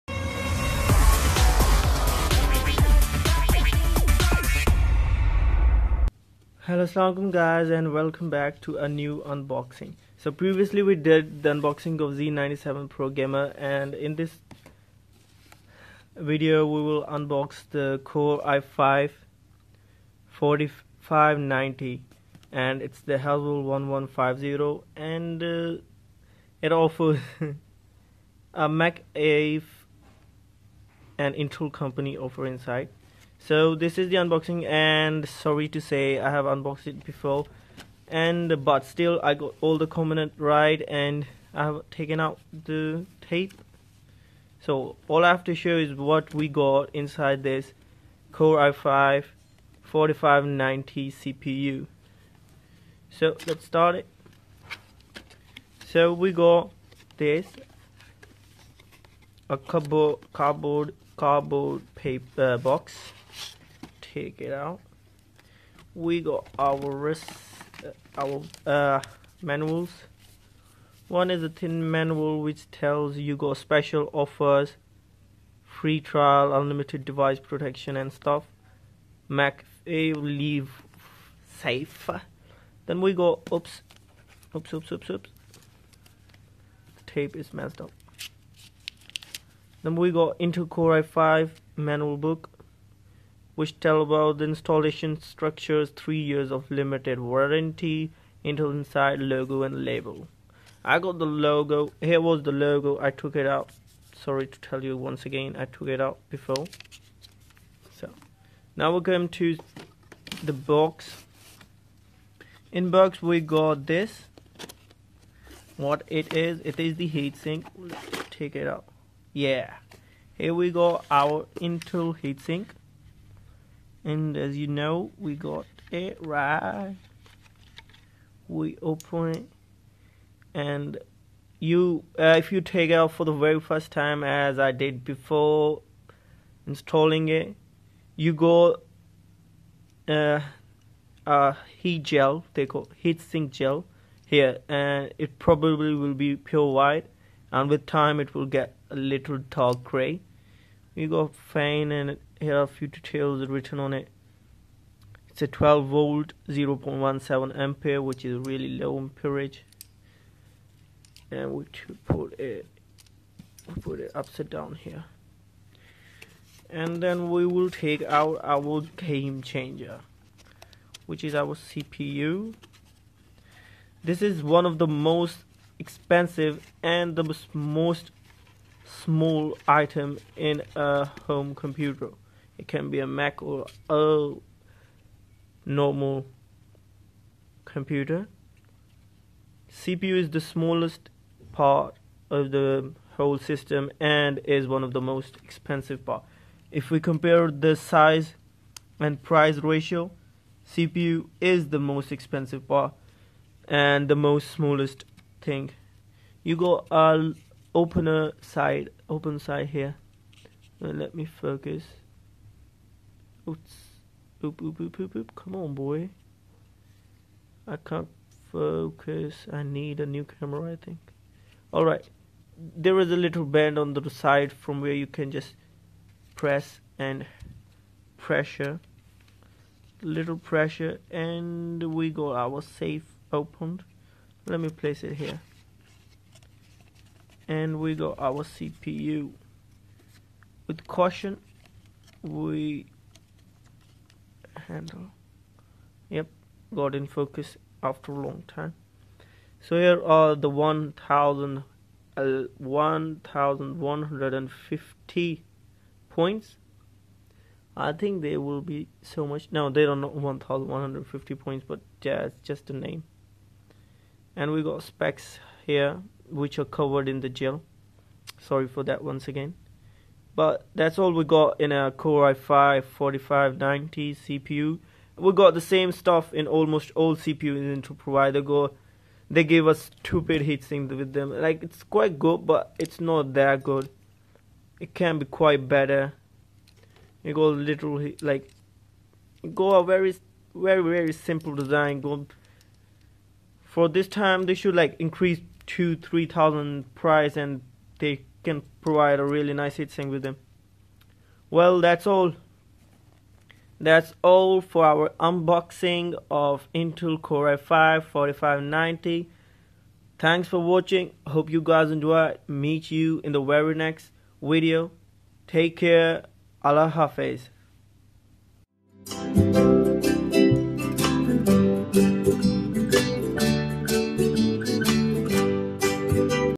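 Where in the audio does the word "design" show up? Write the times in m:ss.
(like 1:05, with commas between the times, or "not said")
4:51.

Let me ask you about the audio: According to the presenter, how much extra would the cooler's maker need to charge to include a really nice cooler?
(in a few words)
2-3 thousand.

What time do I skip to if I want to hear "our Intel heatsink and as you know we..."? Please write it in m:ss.
2:01.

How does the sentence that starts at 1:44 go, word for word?
Sorry to tell you once again, I took it out before.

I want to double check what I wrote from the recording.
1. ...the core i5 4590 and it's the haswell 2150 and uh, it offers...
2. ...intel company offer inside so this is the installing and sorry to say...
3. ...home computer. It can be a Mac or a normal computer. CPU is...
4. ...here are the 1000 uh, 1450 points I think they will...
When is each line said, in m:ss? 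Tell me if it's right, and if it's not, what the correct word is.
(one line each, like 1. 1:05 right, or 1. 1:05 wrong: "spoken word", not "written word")
1. 0:17 wrong: "1150", not "2150"
2. 0:31 wrong: "unboxing", not "installing"
3. 3:01 right
4. 4:09 wrong: "1150", not "1450".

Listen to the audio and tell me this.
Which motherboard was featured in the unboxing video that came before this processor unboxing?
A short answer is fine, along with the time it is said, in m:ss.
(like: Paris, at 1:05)
Z97 Pro Gamer, at 0:12.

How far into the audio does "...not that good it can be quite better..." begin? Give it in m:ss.
4:43.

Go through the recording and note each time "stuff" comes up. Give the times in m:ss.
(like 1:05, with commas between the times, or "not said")
1:18, 4:35.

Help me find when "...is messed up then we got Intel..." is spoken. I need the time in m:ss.
1:27.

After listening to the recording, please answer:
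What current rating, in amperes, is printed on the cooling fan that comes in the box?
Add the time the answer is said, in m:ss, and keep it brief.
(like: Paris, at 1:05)
0.17, at 2:36.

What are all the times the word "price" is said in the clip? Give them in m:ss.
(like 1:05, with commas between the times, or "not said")
3:19, 4:56.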